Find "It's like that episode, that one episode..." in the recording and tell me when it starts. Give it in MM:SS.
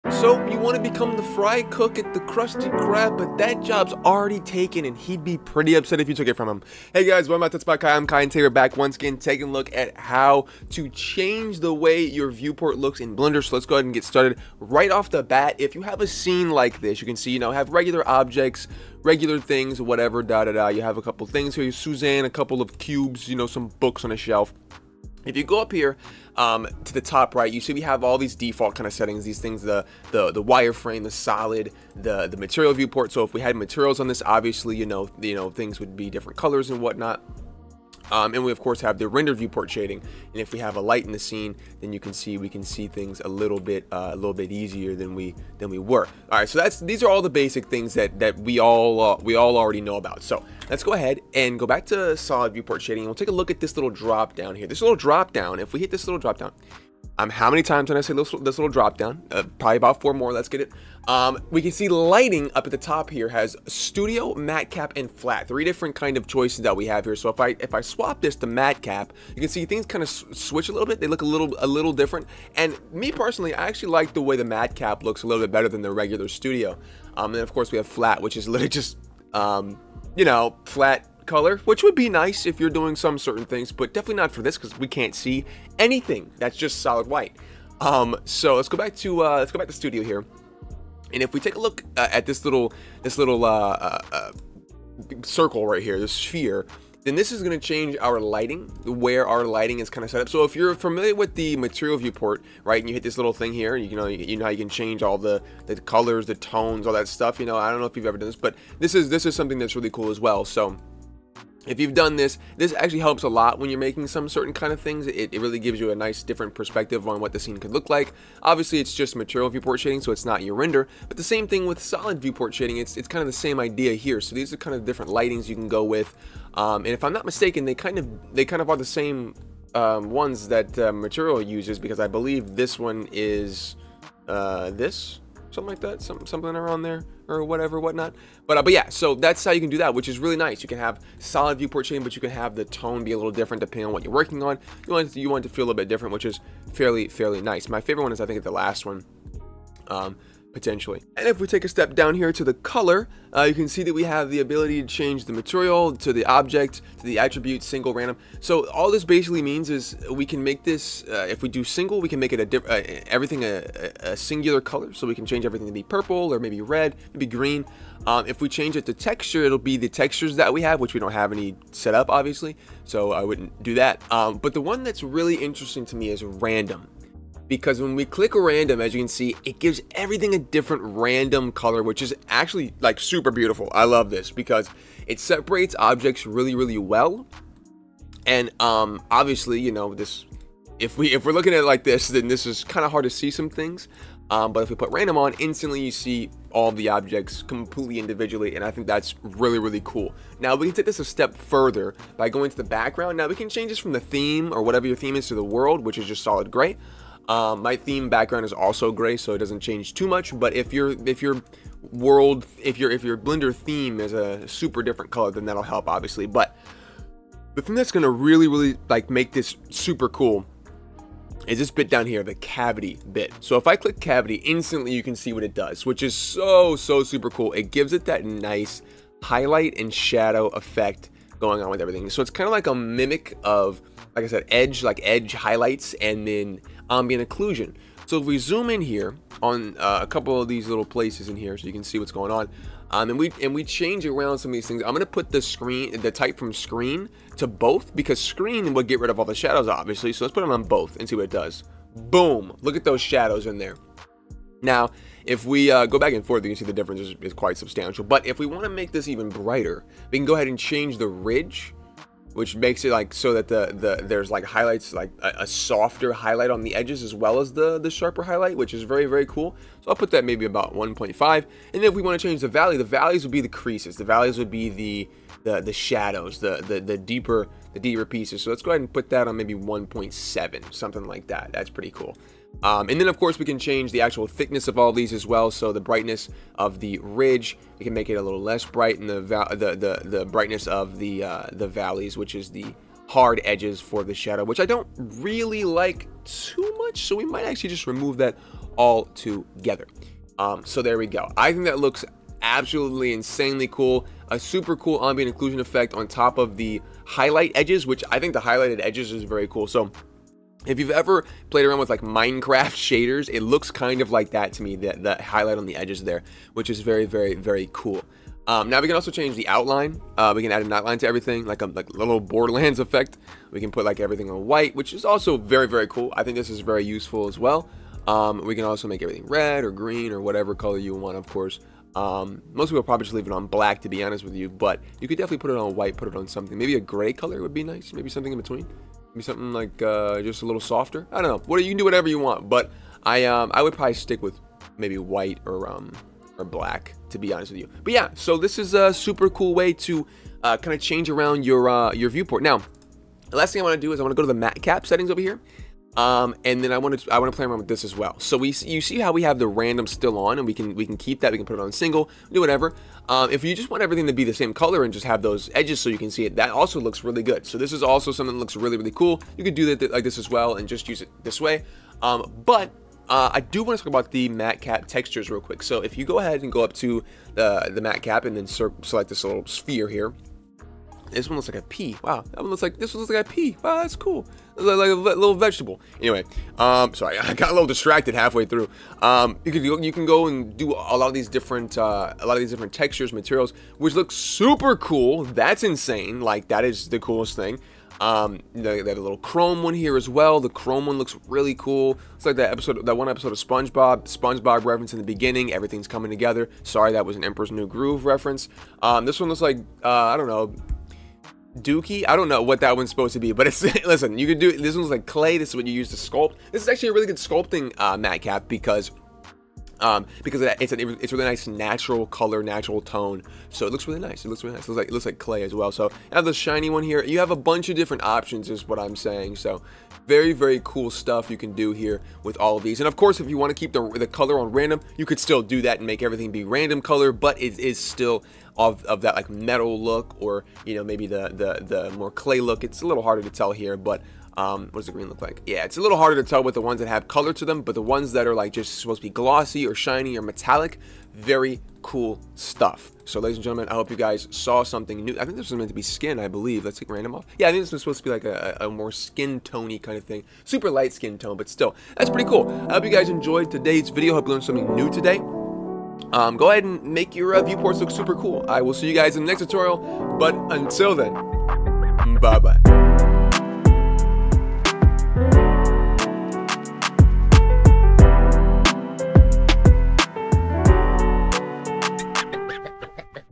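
06:42.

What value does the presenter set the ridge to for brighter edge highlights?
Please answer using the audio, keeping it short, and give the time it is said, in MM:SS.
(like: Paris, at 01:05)
1.5, at 04:30.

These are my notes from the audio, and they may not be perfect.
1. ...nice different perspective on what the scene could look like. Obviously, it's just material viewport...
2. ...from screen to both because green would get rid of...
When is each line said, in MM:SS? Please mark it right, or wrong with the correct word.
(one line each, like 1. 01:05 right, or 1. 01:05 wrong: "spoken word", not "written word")
1. 01:55 right
2. 04:06 wrong: "screen", not "green".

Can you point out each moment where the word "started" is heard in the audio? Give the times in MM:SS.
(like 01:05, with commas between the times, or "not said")
00:14.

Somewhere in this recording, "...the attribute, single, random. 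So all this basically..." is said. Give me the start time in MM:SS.
02:37.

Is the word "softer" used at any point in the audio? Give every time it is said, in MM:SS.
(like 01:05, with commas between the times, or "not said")
04:25, 05:40.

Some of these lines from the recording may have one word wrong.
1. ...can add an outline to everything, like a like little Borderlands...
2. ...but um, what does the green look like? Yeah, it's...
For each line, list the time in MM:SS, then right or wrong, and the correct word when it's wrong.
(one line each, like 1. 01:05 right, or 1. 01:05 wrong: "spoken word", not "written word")
1. 05:20 right
2. 07:23 right.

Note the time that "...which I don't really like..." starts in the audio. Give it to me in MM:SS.
04:54.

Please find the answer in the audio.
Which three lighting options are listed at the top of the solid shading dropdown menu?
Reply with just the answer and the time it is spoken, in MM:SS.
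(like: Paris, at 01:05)
studio, matcap, and flat, at 01:03.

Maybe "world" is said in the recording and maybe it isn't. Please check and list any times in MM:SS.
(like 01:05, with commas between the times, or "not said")
03:25, 03:31.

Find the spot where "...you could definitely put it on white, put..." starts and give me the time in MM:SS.
05:34.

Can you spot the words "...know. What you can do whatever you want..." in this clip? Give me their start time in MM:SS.
05:41.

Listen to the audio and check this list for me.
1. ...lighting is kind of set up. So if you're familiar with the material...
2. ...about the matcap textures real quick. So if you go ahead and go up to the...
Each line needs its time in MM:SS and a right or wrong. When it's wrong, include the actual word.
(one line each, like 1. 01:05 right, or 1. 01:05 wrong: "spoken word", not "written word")
1. 01:39 right
2. 06:13 right.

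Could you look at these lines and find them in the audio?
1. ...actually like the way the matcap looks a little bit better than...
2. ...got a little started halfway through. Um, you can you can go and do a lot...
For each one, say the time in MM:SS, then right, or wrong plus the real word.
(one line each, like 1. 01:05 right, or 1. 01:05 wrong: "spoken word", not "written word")
1. 01:13 right
2. 06:27 wrong: "distracted", not "started".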